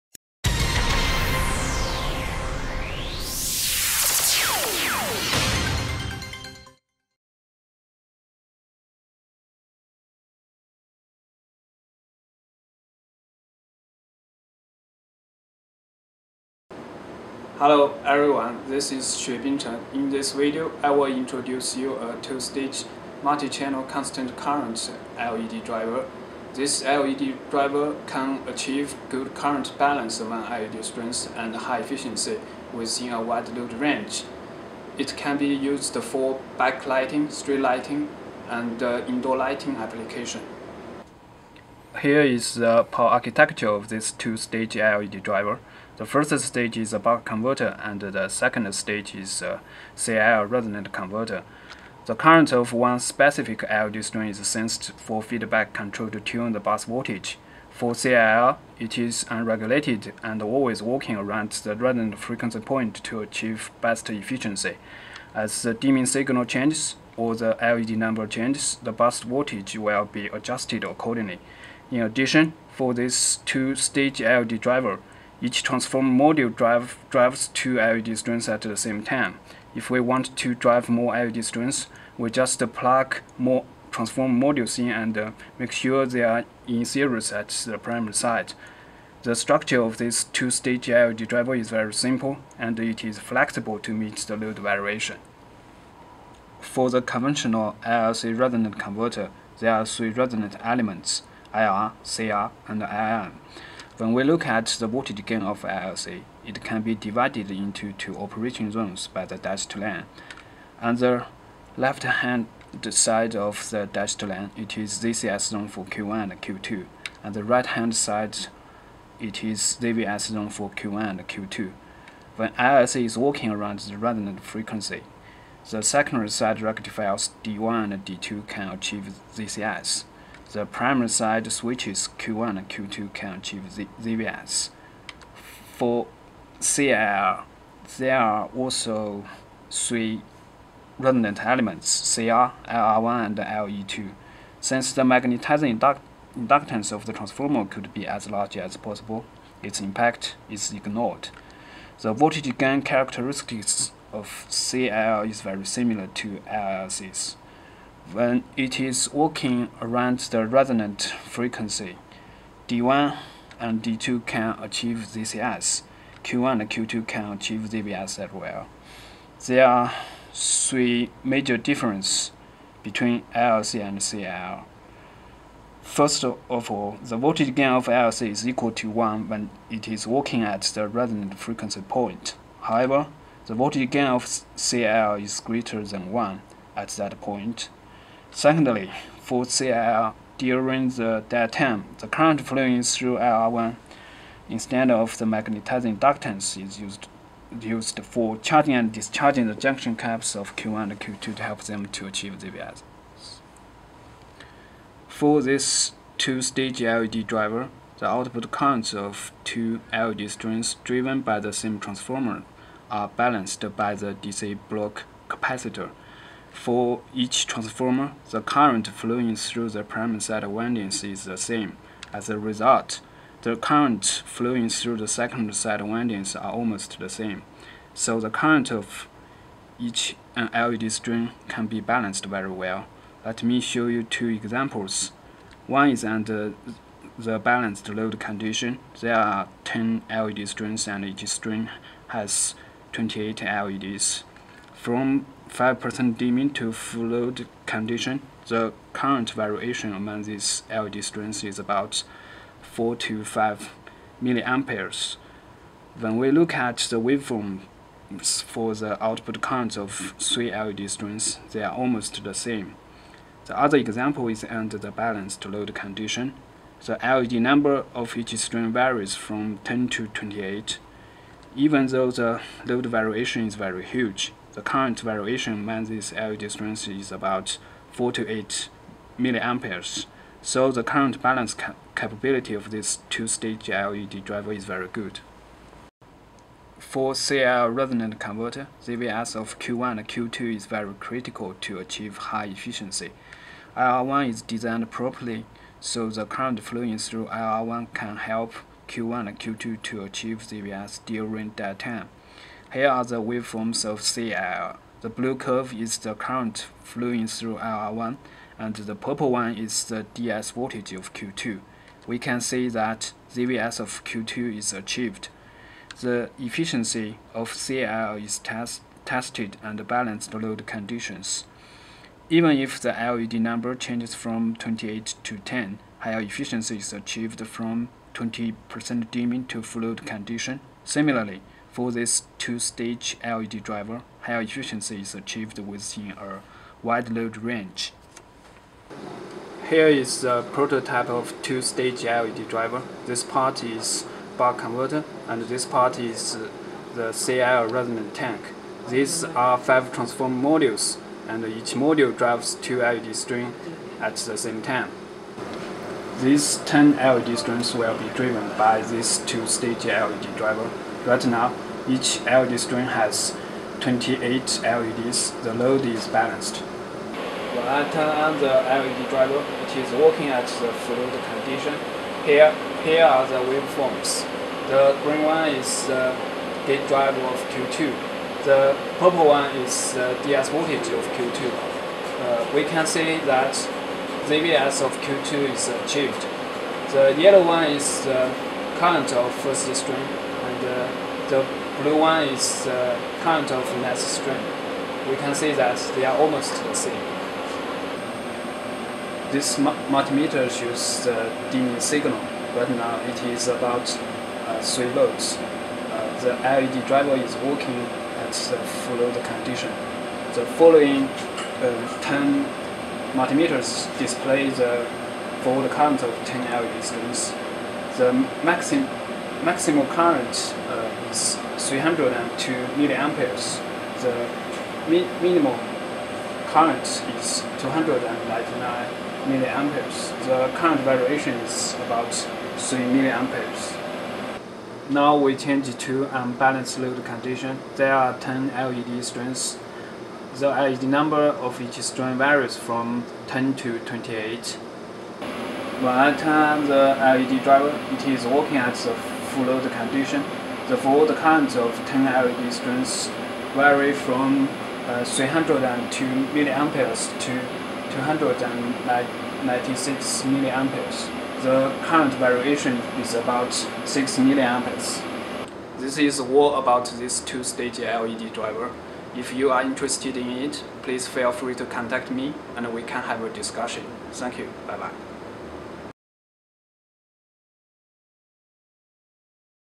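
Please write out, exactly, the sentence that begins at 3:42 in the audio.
As a result, the current flowing through the second side windings are almost the same.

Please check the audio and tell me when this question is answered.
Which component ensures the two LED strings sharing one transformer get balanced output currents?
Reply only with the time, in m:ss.
3:34.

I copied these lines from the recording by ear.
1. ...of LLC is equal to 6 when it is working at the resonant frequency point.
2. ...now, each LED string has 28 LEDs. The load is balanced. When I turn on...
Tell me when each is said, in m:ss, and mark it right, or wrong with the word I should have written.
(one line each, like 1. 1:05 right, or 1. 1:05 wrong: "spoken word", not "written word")
1. 2:57 wrong: "1", not "6"
2. 6:01 right.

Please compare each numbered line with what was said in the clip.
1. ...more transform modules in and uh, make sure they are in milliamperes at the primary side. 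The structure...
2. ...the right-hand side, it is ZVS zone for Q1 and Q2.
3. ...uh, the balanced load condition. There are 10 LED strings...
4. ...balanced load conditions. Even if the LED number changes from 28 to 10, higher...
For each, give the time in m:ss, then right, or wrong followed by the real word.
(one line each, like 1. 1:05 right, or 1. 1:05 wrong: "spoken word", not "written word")
1. 1:23 wrong: "series", not "milliamperes"
2. 1:57 right
3. 3:56 right
4. 5:19 right.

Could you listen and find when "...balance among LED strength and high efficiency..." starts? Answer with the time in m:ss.
0:29.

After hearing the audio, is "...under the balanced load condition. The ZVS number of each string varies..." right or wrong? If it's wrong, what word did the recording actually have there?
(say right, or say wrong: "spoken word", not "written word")
wrong: "LED", not "ZVS".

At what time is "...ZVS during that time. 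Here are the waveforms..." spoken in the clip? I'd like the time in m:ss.
5:00.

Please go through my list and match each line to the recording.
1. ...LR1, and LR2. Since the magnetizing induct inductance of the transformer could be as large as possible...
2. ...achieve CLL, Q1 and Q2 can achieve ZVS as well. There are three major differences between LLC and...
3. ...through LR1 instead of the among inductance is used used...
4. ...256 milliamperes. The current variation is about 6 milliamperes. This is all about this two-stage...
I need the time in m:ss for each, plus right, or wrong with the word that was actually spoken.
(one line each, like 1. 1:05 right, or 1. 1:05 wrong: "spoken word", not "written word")
1. 2:22 right
2. 2:44 wrong: "ZCS", not "CLL"
3. 3:12 wrong: "magnetizing", not "among"
4. 7:37 wrong: "296", not "256".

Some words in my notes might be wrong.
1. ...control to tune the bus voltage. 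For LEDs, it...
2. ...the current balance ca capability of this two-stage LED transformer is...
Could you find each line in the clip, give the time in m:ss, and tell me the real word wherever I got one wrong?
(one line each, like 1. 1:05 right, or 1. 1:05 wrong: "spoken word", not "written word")
1. 0:55 wrong: "CLL", not "LEDs"
2. 4:40 wrong: "driver", not "transformer".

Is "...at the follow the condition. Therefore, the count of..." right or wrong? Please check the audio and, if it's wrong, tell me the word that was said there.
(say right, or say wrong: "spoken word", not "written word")
wrong: "current", not "count".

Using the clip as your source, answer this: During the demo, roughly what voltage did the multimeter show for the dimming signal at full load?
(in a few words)
3 volts.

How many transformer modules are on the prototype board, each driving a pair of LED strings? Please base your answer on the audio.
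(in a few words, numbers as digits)
5.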